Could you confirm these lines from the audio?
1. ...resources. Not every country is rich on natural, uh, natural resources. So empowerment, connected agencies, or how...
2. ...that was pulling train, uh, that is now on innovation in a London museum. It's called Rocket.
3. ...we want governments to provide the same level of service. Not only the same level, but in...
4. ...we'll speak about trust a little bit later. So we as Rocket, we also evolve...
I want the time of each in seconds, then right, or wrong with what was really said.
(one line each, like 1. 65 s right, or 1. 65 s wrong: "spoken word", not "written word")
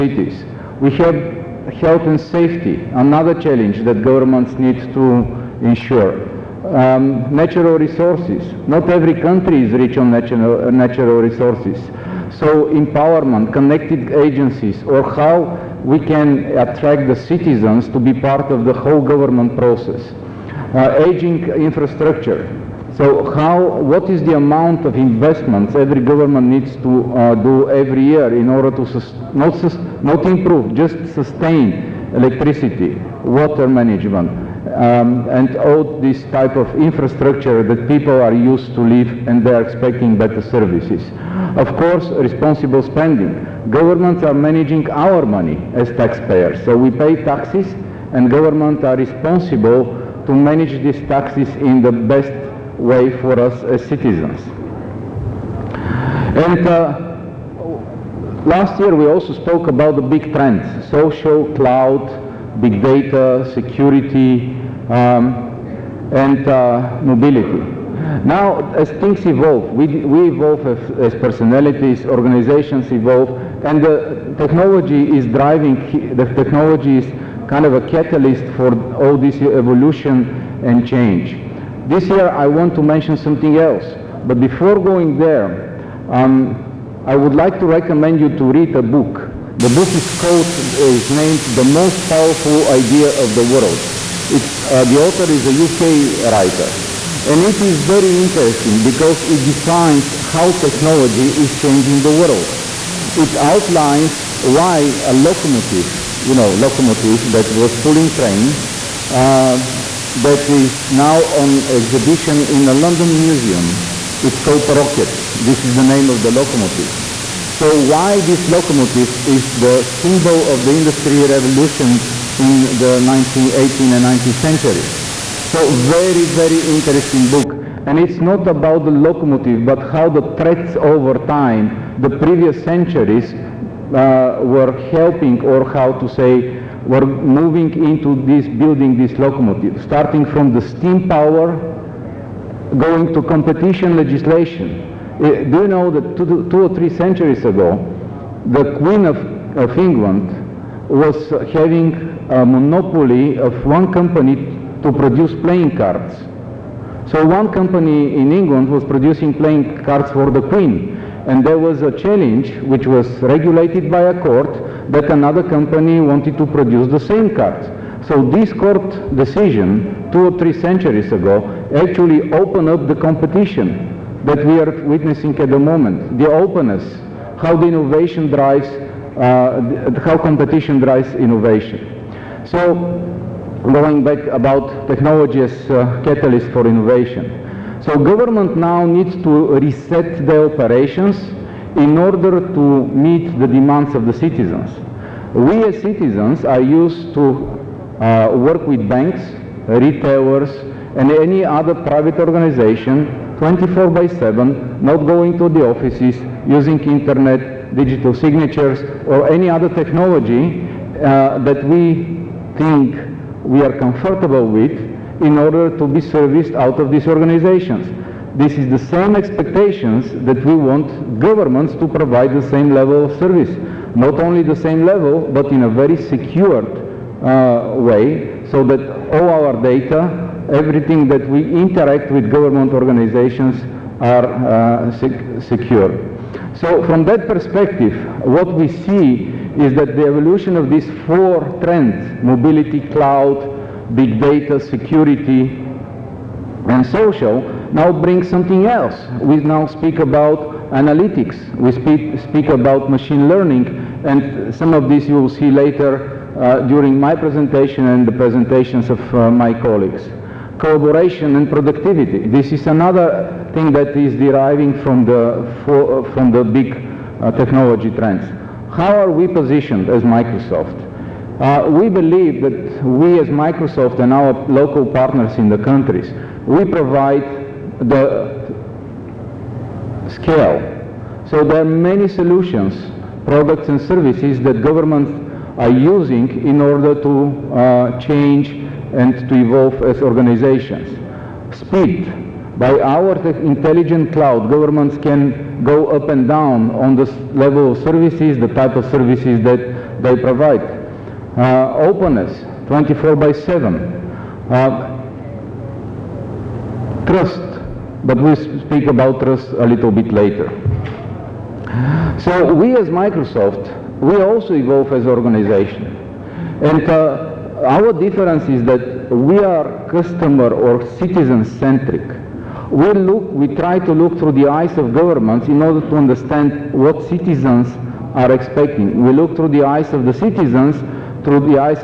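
1. 7 s right
2. 107 s wrong: "exhibition", not "innovation"
3. 220 s right
4. 308 s wrong: "Microsoft", not "Rocket".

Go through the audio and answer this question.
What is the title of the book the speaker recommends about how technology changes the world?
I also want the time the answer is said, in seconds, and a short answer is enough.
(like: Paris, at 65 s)
The Most Powerful Idea of the World, at 91 s.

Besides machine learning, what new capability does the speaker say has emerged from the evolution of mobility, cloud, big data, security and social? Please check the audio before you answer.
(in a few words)
analytics.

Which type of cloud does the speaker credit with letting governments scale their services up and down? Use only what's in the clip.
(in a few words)
intelligent cloud.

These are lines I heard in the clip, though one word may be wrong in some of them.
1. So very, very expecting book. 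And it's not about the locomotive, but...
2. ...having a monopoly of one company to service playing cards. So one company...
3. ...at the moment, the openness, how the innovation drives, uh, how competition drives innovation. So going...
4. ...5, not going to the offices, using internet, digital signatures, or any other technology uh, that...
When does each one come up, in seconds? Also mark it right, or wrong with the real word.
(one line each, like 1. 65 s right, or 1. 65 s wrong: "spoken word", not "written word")
1. 125 s wrong: "interesting", not "expecting"
2. 151 s wrong: "produce", not "service"
3. 175 s right
4. 204 s wrong: "7", not "5".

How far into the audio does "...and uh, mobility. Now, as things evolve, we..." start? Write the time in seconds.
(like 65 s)
66 s.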